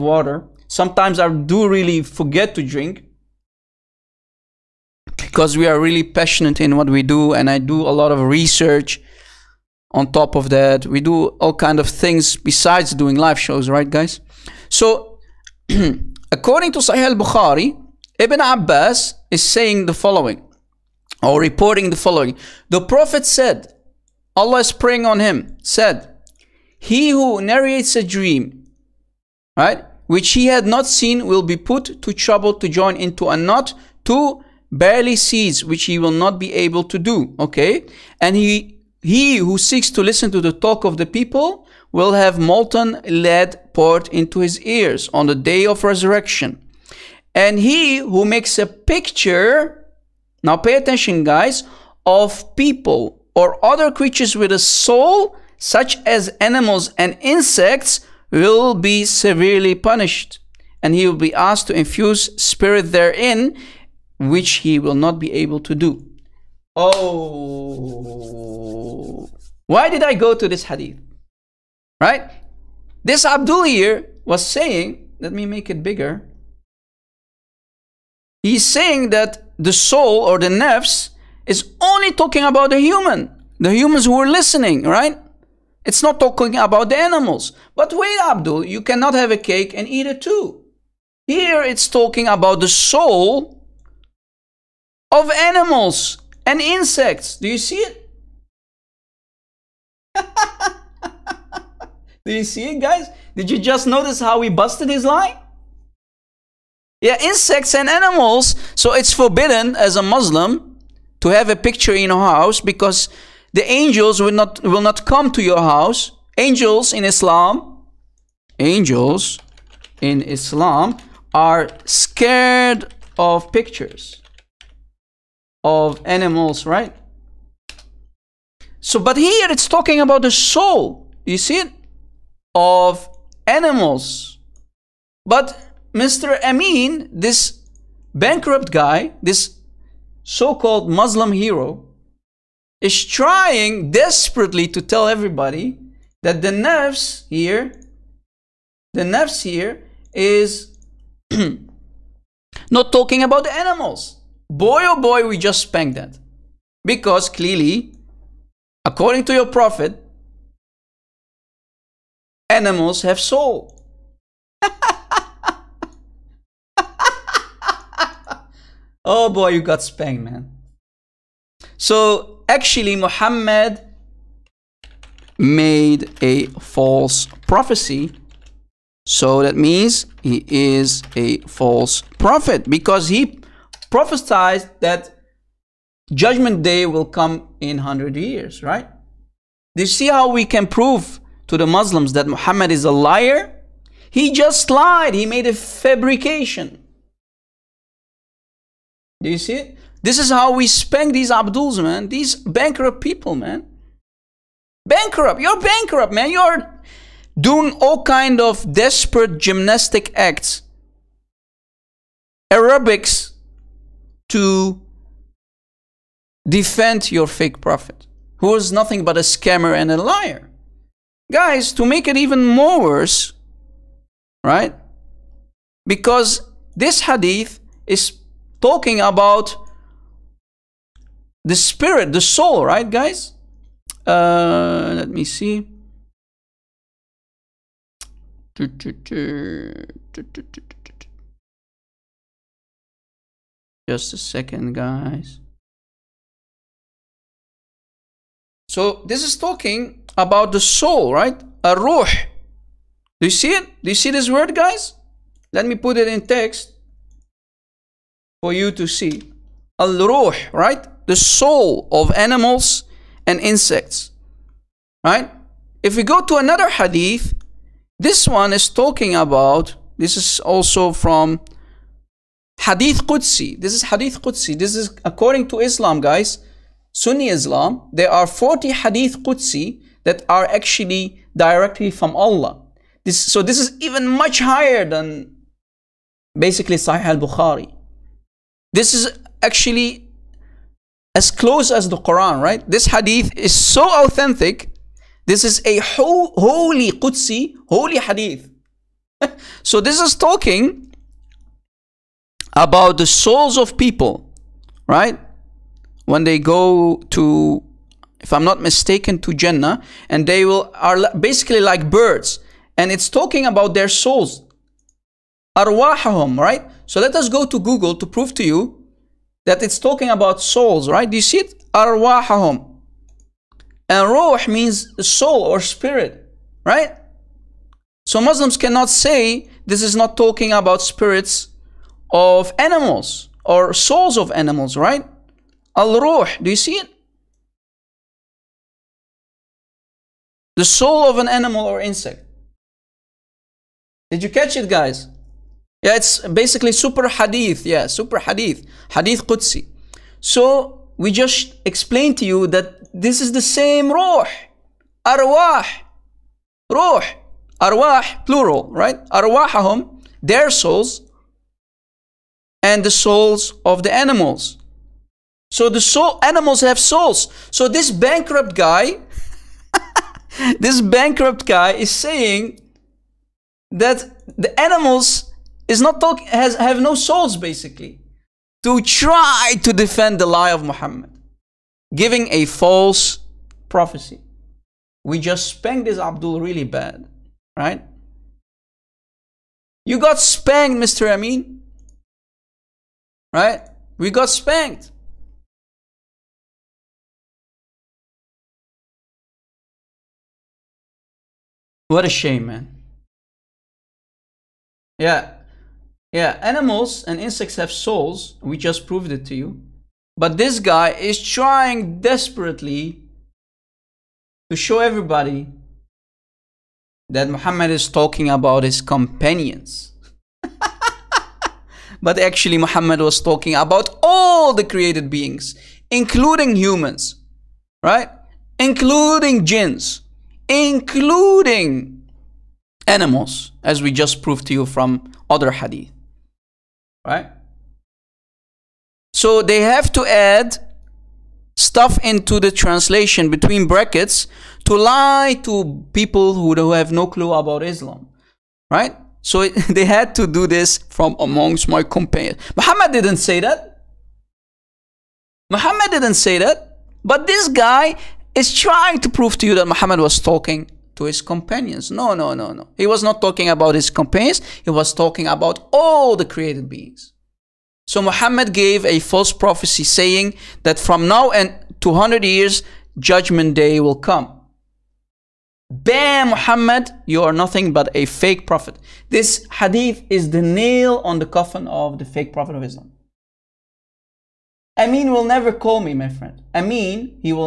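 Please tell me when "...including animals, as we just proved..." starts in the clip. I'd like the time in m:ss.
7:10.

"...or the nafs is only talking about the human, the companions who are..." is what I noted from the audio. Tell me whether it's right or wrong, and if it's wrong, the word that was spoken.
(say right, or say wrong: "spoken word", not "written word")
wrong: "humans", not "companions".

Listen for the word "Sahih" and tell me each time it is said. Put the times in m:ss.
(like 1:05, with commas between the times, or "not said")
0:16, 4:46.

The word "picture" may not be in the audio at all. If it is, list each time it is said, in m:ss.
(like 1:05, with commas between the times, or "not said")
0:48, 1:51, 2:03.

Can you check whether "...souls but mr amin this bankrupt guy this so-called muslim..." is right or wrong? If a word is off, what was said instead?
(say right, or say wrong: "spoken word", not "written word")
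wrong: "animals", not "souls".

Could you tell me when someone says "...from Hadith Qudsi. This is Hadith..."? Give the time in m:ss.
4:30.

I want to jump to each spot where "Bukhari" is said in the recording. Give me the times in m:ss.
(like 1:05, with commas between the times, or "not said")
0:17, 4:47.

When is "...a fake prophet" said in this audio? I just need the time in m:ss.
7:57.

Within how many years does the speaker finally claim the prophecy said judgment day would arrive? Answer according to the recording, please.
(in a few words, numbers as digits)
200.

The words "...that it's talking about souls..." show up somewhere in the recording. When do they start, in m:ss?
5:19.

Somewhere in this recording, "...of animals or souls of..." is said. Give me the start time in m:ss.
5:32.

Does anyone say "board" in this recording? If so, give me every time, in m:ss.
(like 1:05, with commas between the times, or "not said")
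not said.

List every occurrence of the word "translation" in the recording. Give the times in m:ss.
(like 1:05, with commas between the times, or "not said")
7:22.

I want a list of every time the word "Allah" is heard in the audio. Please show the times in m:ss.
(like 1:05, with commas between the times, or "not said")
0:24, 4:42.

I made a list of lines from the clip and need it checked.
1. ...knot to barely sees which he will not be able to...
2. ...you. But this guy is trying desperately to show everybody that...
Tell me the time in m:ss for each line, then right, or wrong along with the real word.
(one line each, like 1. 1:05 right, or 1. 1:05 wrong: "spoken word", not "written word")
1. 0:33 right
2. 6:49 right.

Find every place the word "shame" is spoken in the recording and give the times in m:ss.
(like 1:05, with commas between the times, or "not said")
6:42.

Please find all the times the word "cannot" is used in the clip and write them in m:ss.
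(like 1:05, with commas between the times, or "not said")
1:28, 5:28.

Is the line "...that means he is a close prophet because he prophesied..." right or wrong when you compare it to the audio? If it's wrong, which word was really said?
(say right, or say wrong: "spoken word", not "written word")
wrong: "false", not "close".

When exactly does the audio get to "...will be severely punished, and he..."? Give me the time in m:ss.
0:58.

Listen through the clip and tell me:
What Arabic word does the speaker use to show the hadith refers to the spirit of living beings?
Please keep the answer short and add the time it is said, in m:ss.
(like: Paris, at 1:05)
Al ruh, at 4:19.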